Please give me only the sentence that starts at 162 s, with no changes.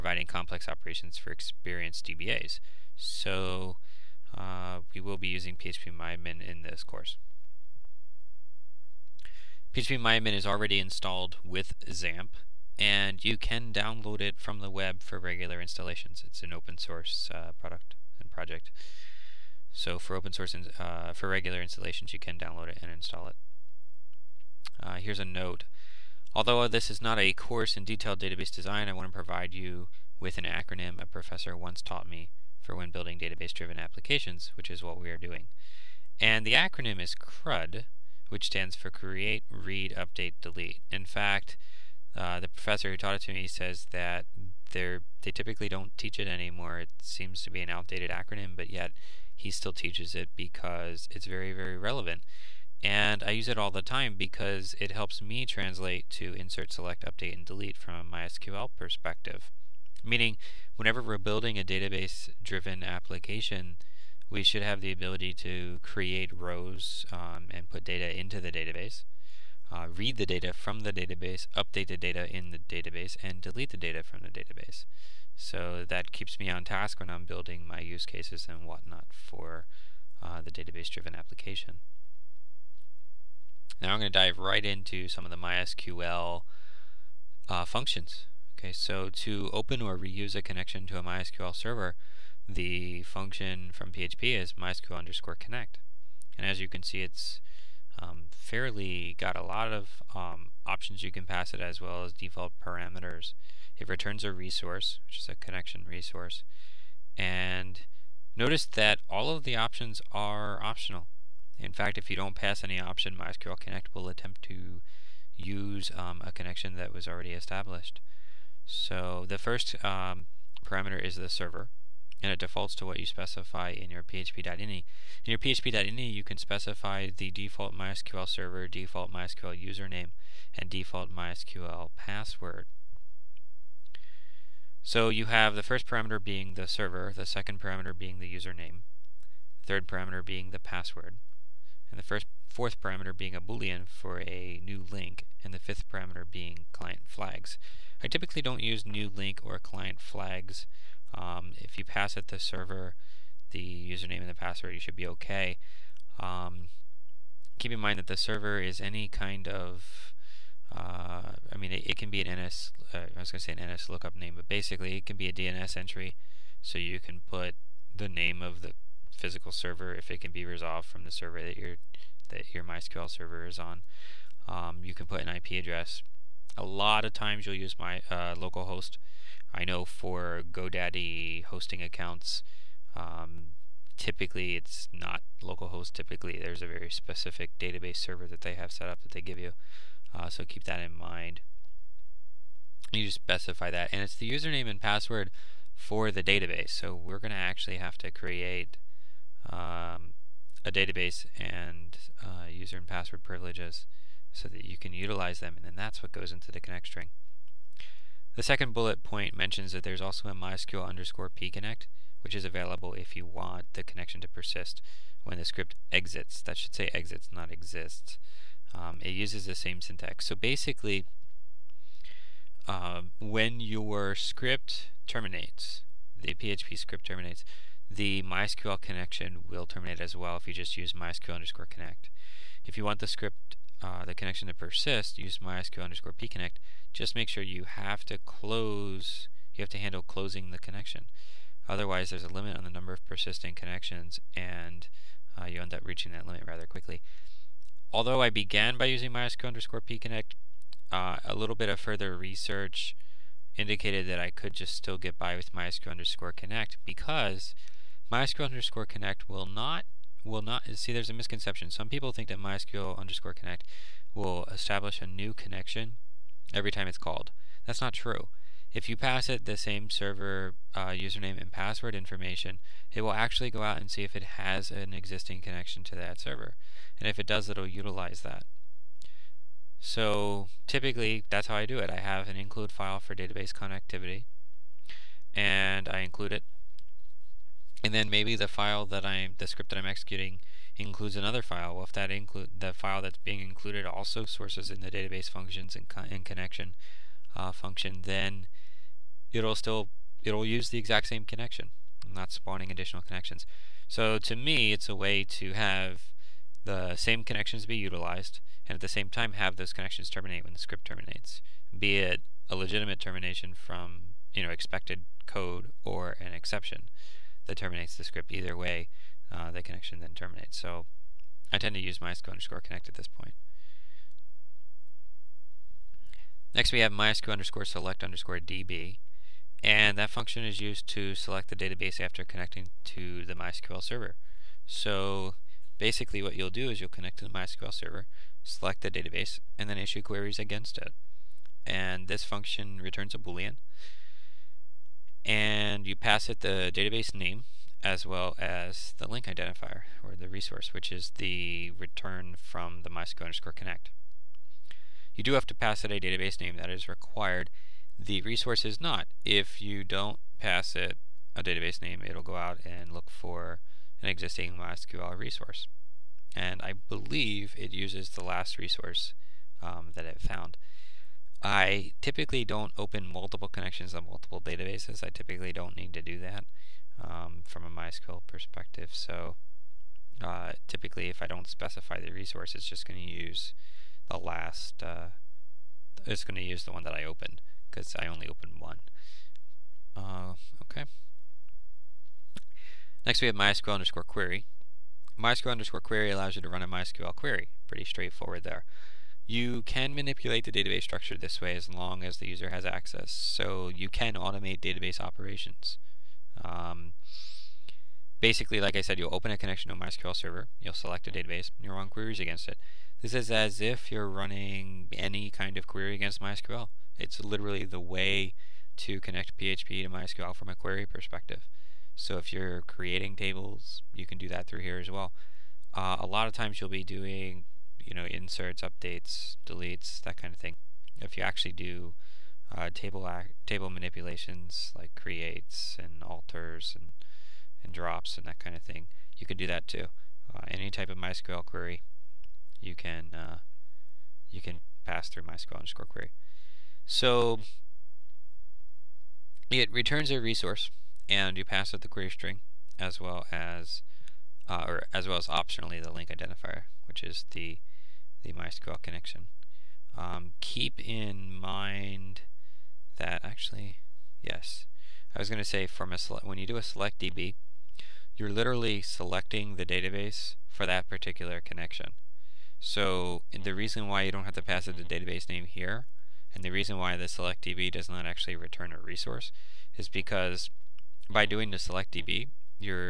Uh, I was going to say an NS lookup name, but basically, it can be a DNS entry.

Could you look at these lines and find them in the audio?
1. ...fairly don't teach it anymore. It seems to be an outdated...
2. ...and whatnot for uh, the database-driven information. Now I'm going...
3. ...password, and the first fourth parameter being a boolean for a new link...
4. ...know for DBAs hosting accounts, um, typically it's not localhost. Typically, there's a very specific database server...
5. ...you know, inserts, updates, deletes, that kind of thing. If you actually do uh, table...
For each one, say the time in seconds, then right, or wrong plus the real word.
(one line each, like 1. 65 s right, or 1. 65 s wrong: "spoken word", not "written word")
1. 45 s wrong: "typically", not "fairly"
2. 78 s wrong: "application", not "information"
3. 140 s right
4. 179 s wrong: "GoDaddy", not "DBAs"
5. 427 s right.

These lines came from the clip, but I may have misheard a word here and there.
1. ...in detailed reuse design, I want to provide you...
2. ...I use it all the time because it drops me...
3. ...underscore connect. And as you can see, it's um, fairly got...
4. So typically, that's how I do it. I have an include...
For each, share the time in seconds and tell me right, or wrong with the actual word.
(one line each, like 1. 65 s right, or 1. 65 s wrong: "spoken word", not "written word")
1. 27 s wrong: "database", not "reuse"
2. 53 s wrong: "helps", not "drops"
3. 94 s right
4. 279 s right.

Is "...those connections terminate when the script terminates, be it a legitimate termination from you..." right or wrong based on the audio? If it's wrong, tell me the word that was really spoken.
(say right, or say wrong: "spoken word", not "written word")
right.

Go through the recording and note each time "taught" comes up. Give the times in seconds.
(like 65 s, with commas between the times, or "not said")
31 s, 42 s.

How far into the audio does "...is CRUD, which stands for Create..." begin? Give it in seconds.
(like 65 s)
37 s.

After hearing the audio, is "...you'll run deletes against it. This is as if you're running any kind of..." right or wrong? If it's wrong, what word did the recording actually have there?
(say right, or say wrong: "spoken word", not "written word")
wrong: "queries", not "deletes".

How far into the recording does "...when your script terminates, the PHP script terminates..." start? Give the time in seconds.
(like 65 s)
223 s.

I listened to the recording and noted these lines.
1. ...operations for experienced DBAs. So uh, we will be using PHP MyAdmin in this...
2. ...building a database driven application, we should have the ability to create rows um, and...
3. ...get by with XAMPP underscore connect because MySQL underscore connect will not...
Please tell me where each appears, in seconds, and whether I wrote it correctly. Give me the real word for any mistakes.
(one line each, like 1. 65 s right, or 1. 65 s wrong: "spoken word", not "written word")
1. 0 s right
2. 61 s right
3. 254 s wrong: "MySQL", not "XAMPP".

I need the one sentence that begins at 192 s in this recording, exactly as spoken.
You just specify that, and it's the username and password for the database.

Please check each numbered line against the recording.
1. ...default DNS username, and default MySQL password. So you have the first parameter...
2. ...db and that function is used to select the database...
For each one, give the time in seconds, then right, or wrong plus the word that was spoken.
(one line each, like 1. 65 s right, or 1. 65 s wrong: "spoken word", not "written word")
1. 128 s wrong: "MySQL", not "DNS"
2. 328 s right.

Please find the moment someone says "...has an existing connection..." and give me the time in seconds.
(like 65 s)
274 s.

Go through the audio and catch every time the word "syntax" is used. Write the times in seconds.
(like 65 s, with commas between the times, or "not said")
219 s.